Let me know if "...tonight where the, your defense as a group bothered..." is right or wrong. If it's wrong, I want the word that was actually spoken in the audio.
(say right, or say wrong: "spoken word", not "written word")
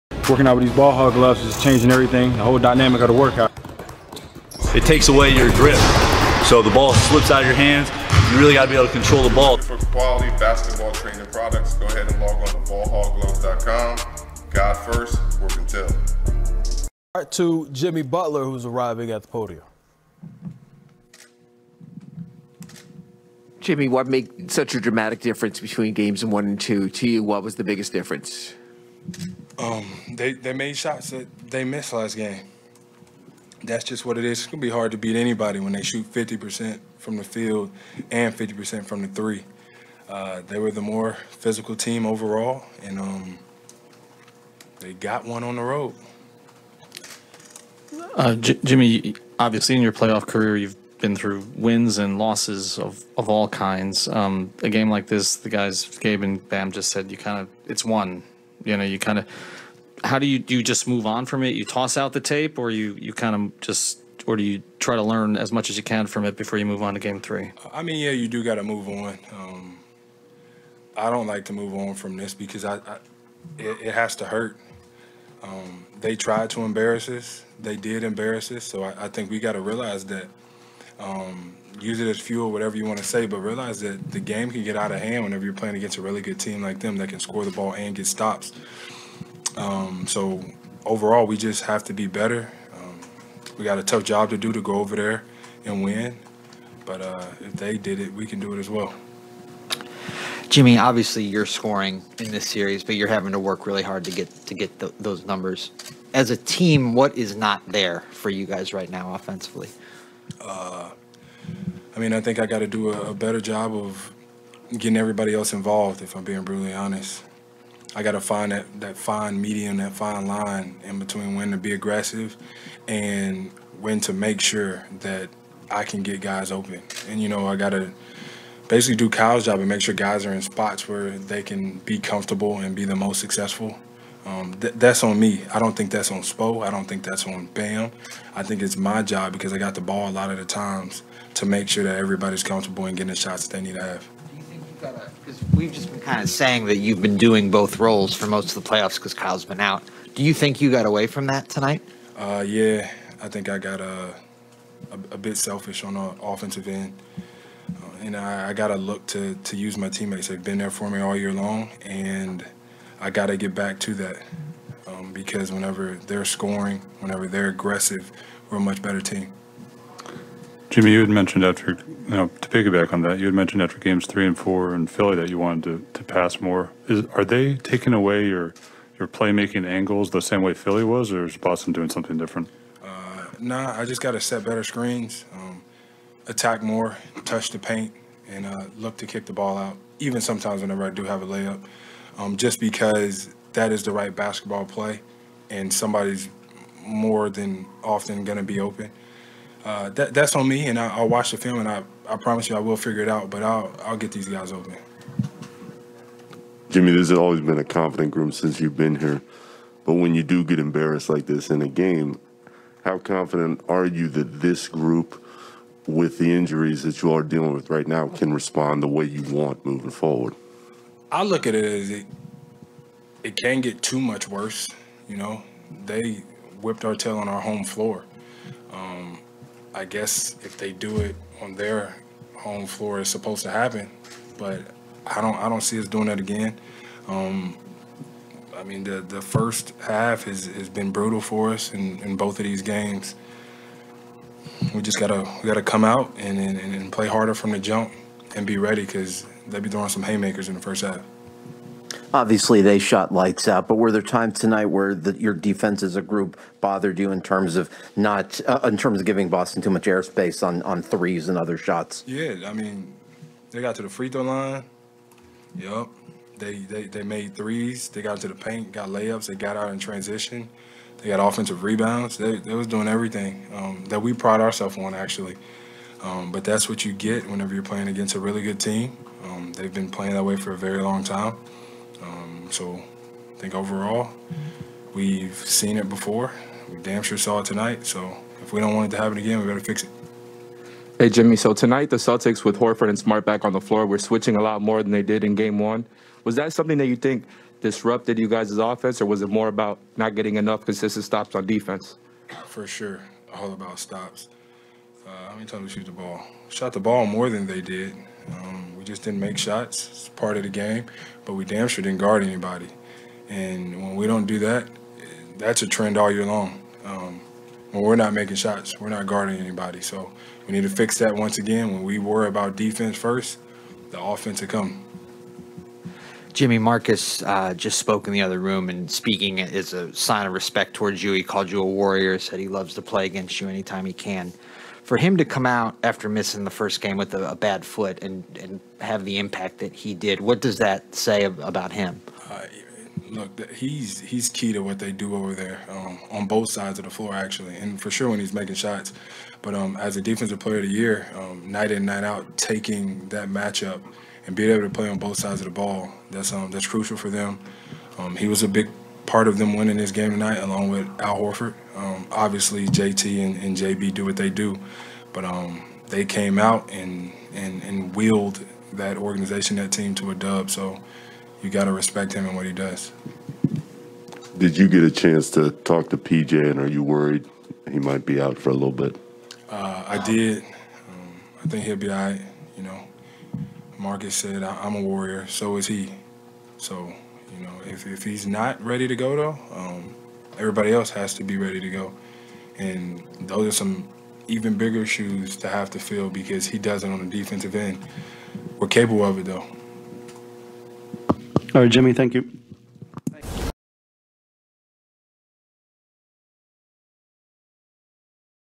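right.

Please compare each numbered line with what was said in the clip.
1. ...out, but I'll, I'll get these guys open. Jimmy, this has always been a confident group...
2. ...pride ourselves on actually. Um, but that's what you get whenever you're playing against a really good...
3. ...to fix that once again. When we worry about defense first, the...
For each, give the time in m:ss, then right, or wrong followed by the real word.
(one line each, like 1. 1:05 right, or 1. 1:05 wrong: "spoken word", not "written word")
1. 3:23 right
2. 4:34 right
3. 5:20 right.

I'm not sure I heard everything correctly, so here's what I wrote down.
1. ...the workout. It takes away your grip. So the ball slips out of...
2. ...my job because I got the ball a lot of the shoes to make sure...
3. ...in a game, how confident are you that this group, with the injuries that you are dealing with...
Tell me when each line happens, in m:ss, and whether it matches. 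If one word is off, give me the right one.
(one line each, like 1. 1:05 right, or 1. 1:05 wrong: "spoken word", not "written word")
1. 0:03 right
2. 2:18 wrong: "times", not "shoes"
3. 3:31 right.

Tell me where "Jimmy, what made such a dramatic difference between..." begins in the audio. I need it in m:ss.
0:23.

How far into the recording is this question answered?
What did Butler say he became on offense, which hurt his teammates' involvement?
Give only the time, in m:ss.
2:35.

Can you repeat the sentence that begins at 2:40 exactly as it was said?
They've been there for me all year long.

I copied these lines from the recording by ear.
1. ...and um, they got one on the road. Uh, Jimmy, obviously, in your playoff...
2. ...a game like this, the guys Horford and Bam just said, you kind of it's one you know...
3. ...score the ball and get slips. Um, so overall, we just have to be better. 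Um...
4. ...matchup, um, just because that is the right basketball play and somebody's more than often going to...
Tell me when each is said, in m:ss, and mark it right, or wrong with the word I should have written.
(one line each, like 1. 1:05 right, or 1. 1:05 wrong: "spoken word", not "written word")
1. 0:42 right
2. 0:54 wrong: "Gabe", not "Horford"
3. 1:27 wrong: "stops", not "slips"
4. 3:11 wrong: "layup", not "matchup".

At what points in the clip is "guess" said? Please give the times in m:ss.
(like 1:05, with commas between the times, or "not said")
3:49.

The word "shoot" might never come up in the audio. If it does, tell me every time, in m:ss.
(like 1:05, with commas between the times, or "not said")
0:35, 5:05.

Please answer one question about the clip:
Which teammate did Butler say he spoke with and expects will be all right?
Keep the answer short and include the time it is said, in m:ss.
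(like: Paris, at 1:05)
PJ, at 6:15.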